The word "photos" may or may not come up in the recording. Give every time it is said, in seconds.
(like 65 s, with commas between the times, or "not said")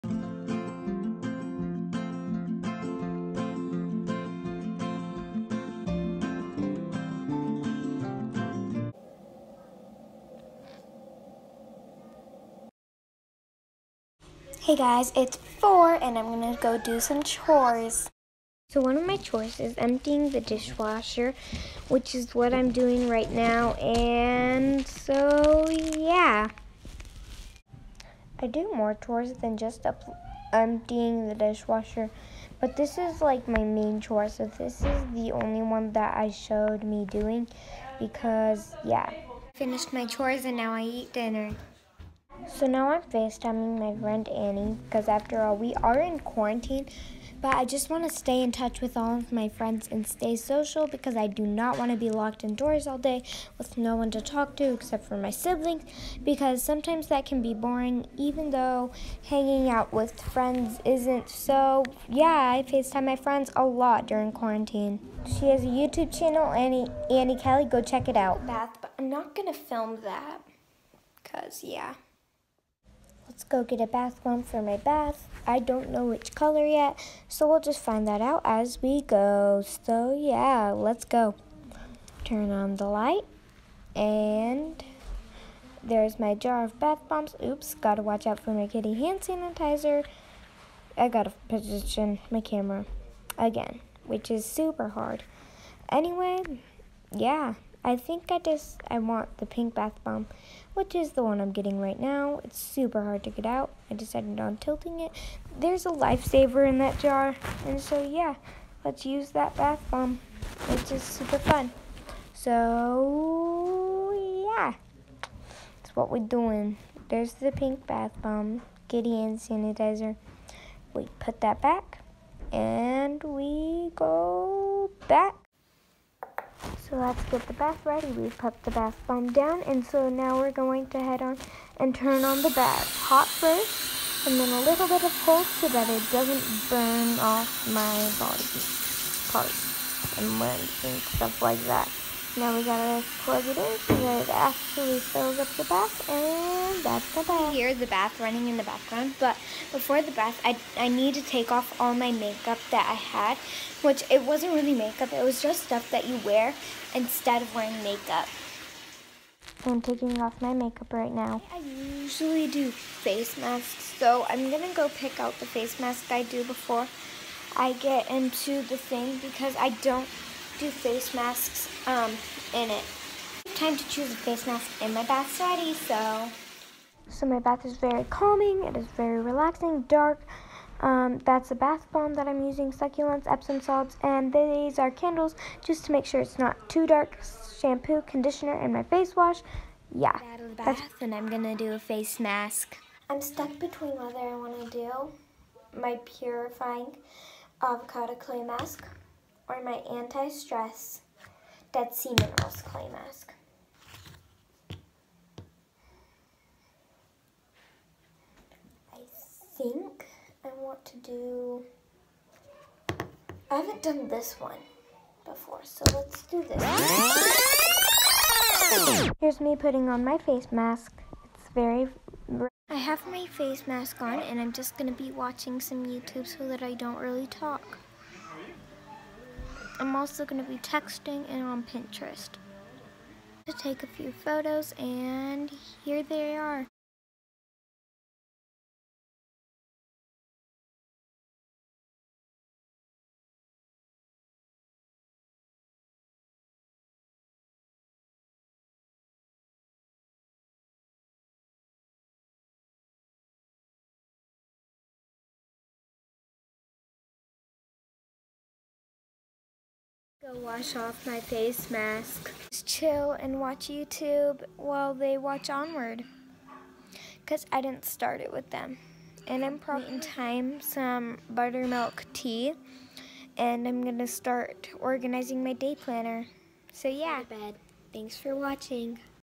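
234 s.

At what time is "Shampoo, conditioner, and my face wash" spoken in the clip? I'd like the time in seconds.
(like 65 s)
187 s.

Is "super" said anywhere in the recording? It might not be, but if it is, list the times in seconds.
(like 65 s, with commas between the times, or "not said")
94 s, 102 s, 111 s.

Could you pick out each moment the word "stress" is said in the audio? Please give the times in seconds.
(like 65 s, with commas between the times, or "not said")
199 s.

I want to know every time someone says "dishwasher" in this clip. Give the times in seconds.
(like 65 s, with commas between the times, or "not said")
20 s, 31 s.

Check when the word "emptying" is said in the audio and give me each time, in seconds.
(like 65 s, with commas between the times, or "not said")
19 s, 30 s.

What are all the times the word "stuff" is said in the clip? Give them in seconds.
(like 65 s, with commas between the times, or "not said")
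140 s, 155 s.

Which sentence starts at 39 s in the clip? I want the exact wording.
Finished my chores and now I eat dinner.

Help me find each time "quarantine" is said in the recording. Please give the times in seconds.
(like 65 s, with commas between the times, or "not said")
46 s, 64 s.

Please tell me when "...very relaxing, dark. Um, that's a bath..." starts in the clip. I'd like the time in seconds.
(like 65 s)
178 s.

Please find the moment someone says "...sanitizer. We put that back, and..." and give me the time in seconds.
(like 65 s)
119 s.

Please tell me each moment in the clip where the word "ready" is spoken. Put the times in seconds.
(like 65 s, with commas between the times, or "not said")
127 s, 175 s.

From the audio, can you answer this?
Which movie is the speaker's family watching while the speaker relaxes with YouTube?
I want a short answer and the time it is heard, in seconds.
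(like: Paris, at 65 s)
Onward, at 265 s.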